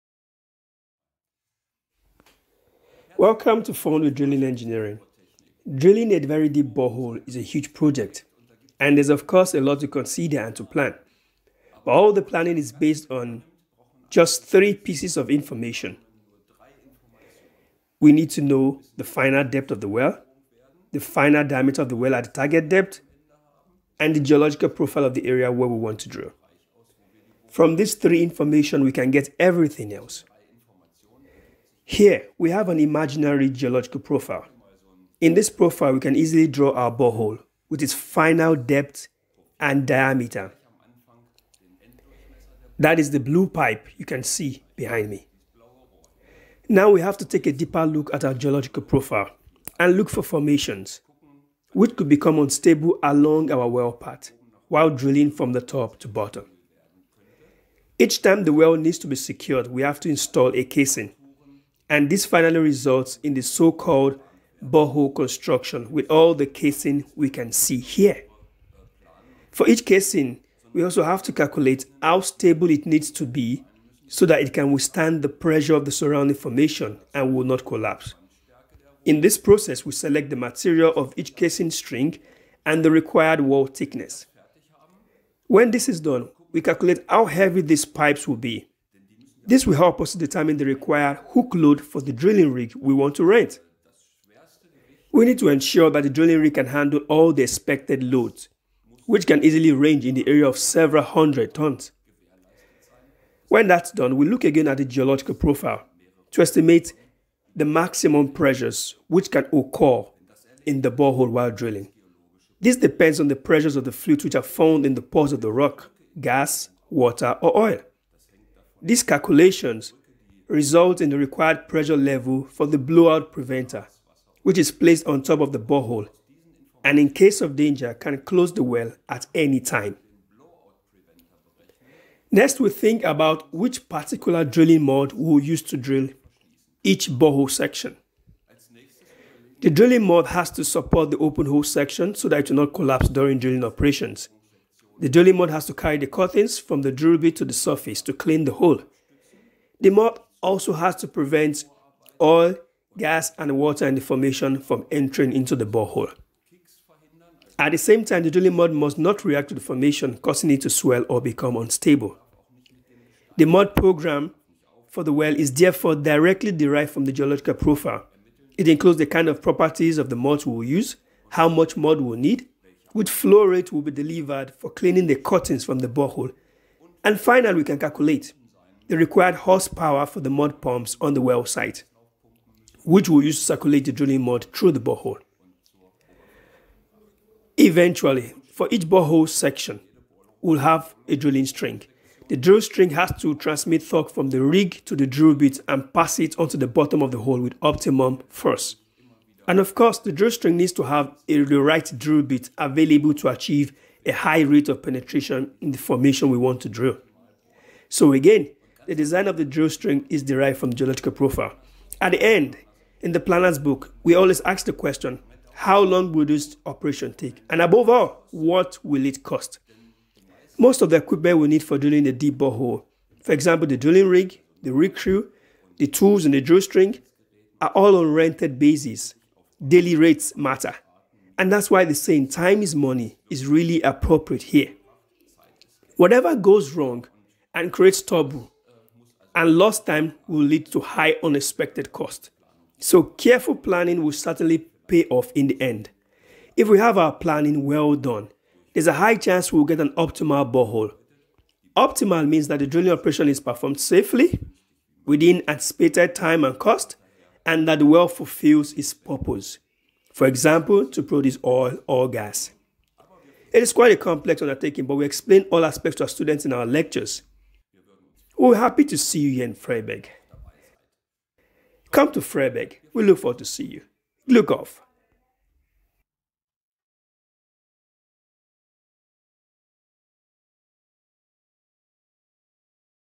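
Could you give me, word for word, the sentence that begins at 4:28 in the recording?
We're happy to see you here in Freiberg.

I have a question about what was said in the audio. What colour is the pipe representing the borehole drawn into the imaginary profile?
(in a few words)
blue.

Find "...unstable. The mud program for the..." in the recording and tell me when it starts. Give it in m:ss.
2:41.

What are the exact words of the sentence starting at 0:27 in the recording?
From these three information, we can get everything else.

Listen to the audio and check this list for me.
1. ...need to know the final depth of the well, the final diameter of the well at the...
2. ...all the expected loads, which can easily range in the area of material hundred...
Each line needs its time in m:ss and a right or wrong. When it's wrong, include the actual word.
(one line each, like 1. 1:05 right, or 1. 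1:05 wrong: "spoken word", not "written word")
1. 0:18 right
2. 1:37 wrong: "several", not "material".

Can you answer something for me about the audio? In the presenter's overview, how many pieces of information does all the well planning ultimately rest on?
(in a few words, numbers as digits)
3.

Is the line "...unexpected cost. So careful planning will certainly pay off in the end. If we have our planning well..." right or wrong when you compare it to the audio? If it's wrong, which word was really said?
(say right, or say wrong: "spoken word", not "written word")
right.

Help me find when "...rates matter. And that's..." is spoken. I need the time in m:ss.
3:49.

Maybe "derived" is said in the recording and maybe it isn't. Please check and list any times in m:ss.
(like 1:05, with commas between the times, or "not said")
2:46, 3:30.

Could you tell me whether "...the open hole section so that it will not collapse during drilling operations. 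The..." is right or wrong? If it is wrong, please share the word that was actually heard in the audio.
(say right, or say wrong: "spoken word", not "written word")
right.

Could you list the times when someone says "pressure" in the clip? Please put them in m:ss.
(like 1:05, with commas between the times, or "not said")
1:15, 1:48, 1:53, 2:01.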